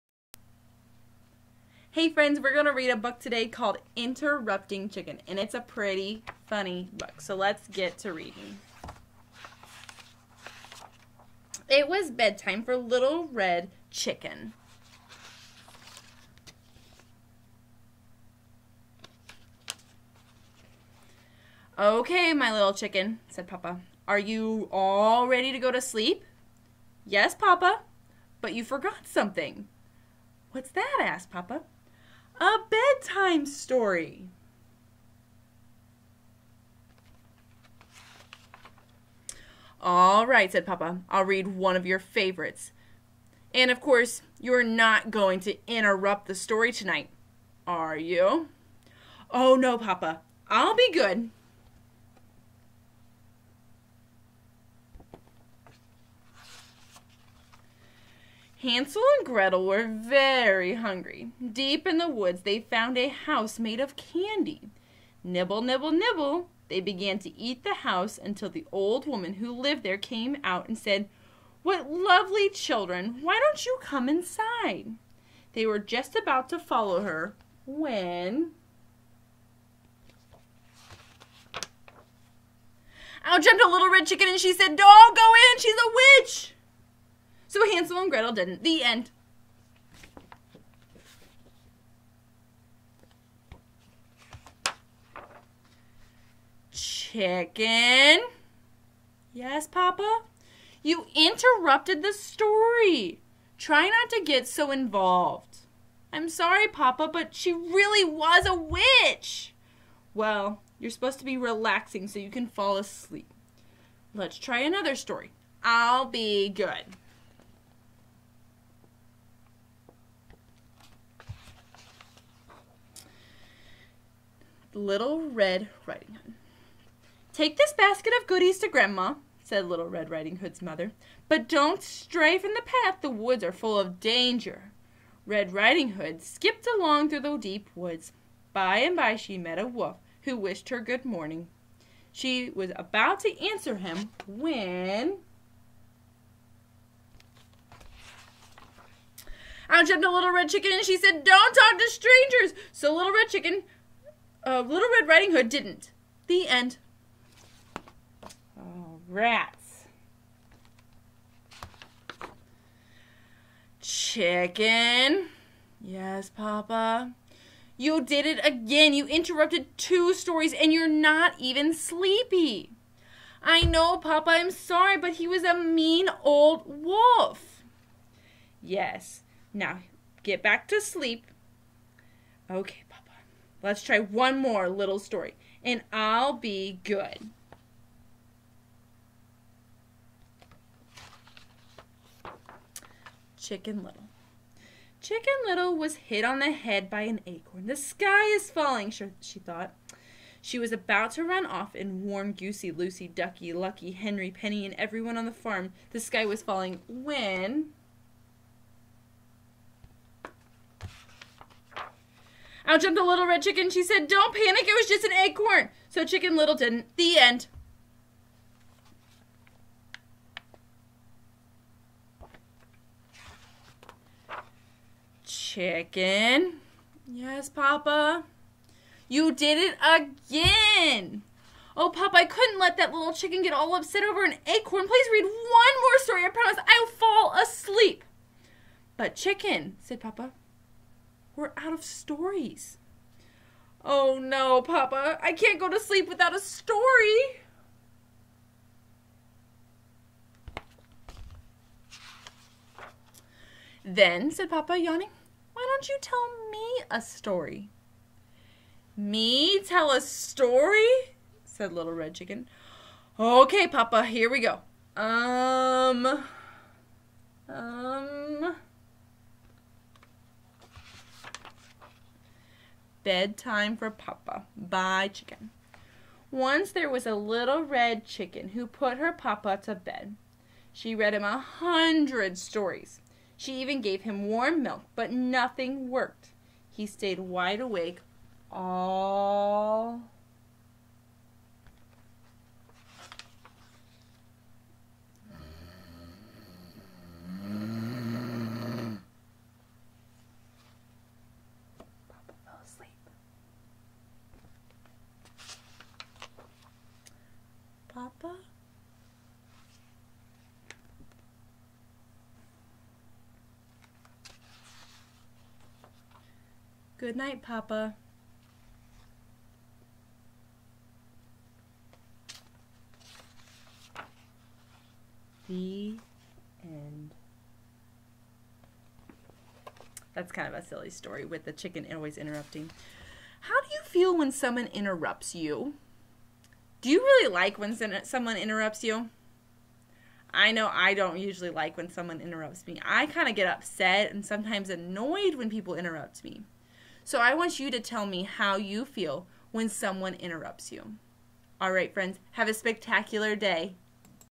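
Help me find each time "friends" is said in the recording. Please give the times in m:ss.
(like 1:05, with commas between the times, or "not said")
0:02, 5:51.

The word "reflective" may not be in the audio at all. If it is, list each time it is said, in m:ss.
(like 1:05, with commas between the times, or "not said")
not said.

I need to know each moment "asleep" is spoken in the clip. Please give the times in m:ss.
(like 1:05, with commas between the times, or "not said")
1:52, 3:57.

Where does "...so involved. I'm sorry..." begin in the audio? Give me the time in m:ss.
1:44.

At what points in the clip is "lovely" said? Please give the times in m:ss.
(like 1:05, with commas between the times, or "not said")
1:11.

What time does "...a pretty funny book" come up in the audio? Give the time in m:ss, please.
0:05.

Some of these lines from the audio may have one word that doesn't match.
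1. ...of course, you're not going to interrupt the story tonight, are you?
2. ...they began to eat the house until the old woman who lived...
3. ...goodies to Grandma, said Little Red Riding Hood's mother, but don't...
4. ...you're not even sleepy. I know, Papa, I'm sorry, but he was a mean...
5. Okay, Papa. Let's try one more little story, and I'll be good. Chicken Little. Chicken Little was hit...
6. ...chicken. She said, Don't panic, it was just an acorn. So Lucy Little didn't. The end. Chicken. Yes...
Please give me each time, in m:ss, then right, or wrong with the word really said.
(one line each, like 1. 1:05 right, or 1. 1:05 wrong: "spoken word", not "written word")
1. 0:43 right
2. 1:06 right
3. 2:08 right
4. 2:50 right
5. 3:02 right
6. 3:33 wrong: "Chicken", not "Lucy".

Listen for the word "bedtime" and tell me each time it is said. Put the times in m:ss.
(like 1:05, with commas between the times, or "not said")
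0:12, 0:32, 4:33.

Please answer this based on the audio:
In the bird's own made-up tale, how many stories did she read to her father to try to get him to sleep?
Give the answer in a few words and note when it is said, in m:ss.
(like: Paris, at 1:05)
100, at 4:41.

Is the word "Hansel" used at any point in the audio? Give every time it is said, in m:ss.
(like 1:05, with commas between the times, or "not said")
0:58, 1:27.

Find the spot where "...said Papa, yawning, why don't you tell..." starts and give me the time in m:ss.
4:14.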